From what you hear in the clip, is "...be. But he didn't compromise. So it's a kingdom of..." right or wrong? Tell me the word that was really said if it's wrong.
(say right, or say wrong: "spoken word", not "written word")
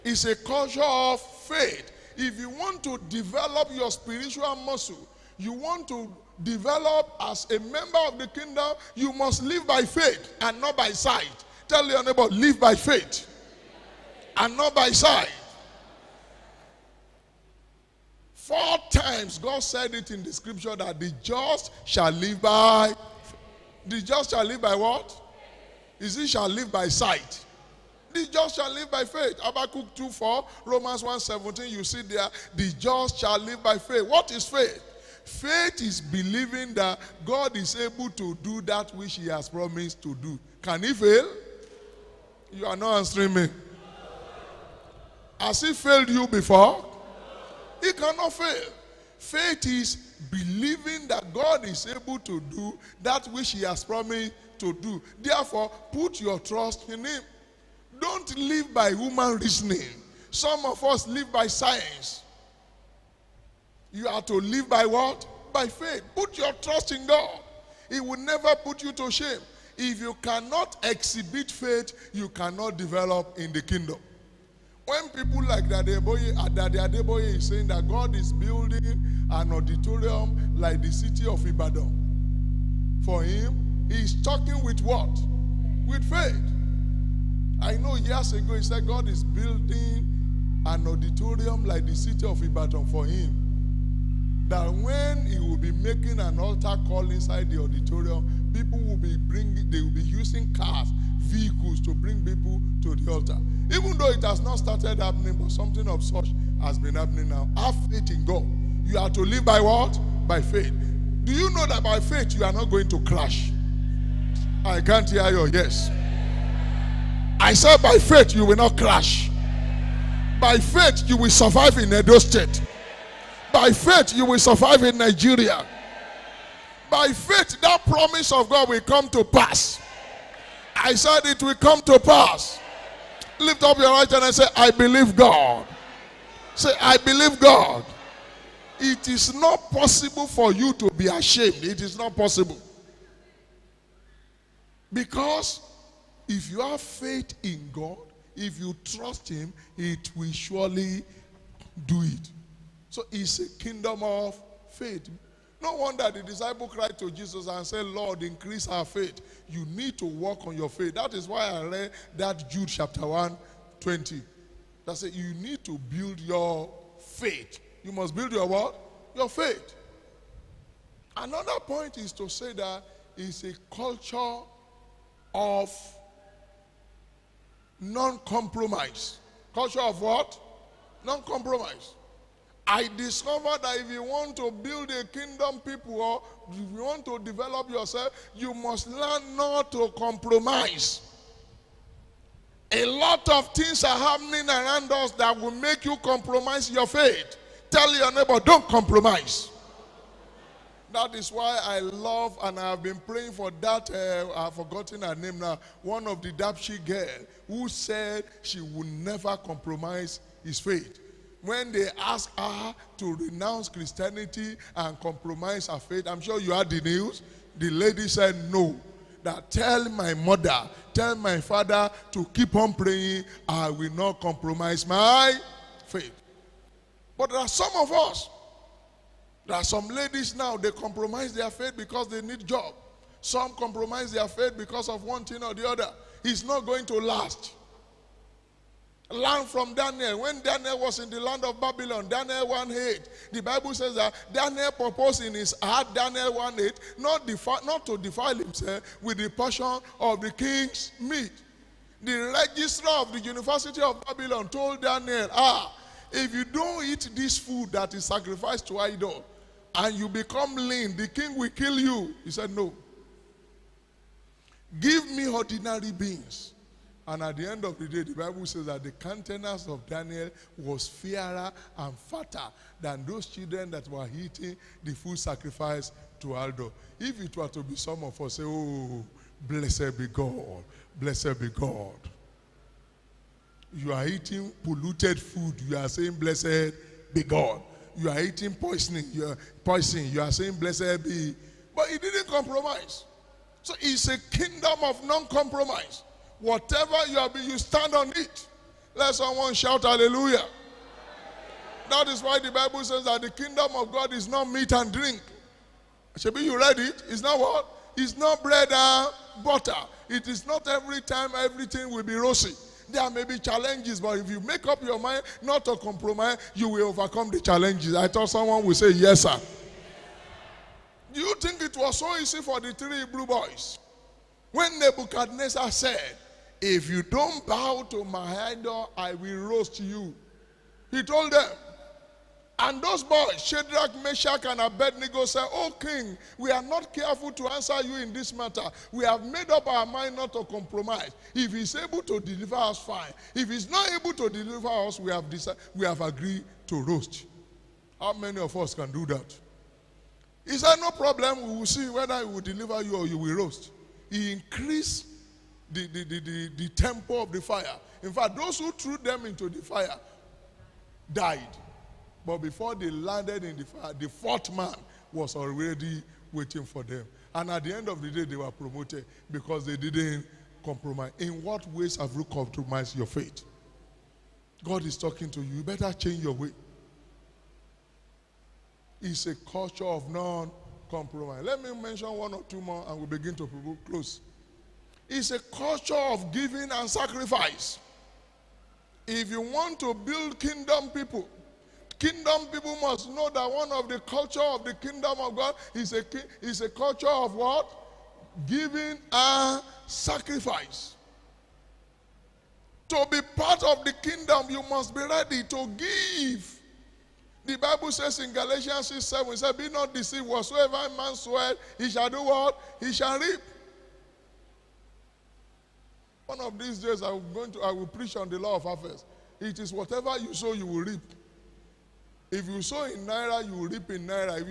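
right.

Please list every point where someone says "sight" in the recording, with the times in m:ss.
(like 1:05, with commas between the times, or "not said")
0:10, 0:14, 0:26.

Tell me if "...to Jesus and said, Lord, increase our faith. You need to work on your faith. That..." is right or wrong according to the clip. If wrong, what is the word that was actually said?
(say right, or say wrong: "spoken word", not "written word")
right.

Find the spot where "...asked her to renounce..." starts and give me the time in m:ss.
3:31.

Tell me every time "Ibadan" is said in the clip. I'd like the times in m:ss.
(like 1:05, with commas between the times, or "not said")
1:21, 1:32.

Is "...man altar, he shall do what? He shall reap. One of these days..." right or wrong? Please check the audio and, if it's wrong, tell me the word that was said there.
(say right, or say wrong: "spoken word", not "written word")
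wrong: "swear", not "altar".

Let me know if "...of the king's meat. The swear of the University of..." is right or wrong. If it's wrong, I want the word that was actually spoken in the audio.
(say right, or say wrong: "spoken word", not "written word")
wrong: "registrar", not "swear".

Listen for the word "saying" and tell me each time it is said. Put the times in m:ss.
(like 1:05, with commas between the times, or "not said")
1:17, 4:45, 4:50.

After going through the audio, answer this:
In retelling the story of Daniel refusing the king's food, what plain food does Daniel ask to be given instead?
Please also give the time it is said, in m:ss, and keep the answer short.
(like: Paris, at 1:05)
ordinary beans, at 4:25.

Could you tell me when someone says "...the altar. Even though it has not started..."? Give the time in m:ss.
1:42.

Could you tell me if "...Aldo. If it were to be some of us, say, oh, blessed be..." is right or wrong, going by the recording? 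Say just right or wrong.
right.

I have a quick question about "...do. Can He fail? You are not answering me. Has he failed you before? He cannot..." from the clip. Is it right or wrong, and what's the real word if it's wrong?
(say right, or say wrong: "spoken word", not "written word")
right.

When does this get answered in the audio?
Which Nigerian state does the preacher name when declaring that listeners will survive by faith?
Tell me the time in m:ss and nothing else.
2:01.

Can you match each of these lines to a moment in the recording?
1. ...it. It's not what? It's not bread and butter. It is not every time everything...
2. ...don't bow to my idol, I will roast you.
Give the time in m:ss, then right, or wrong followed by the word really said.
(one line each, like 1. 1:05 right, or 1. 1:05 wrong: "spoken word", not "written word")
1. 5:06 right
2. 5:27 right.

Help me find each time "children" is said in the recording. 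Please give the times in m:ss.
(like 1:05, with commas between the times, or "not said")
4:33.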